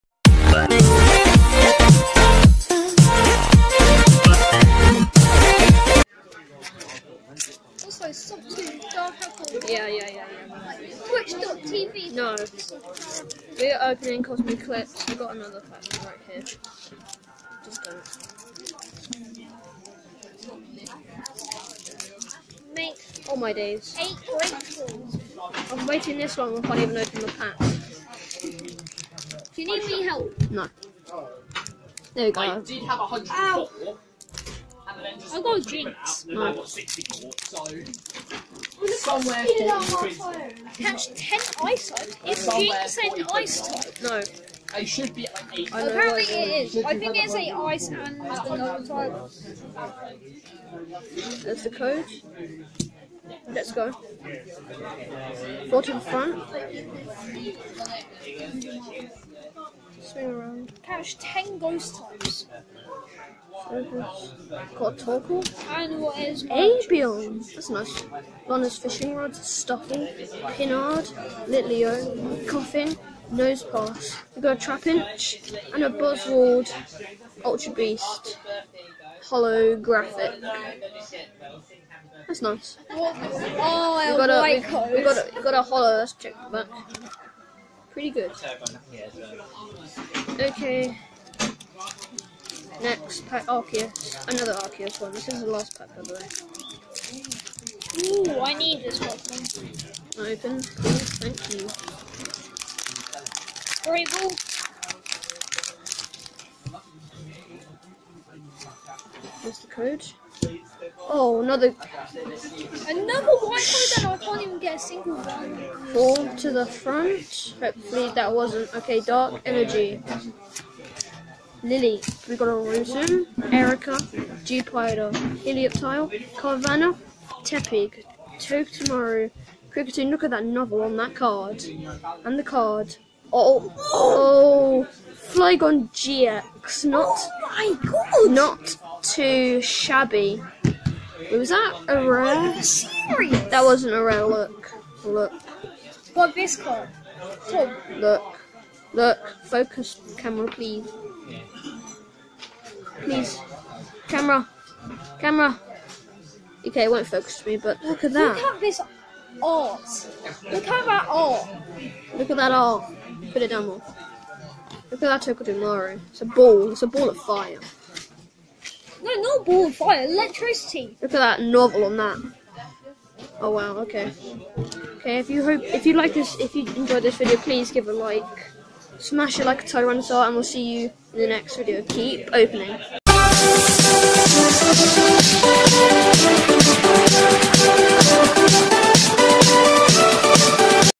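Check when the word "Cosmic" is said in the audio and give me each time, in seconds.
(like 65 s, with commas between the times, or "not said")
14 s.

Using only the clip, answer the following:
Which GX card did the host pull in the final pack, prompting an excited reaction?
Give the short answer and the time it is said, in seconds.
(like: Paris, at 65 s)
Flygon GX, at 135 s.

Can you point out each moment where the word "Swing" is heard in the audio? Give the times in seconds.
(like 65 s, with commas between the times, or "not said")
60 s.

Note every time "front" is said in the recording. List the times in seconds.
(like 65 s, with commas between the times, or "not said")
55 s, 116 s.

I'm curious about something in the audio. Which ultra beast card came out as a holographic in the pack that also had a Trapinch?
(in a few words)
Buzzwole.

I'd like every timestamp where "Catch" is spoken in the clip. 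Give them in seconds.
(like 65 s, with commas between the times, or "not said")
40 s, 60 s.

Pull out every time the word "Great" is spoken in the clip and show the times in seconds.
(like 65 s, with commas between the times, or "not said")
103 s.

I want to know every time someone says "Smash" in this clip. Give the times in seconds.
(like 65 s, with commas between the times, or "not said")
178 s.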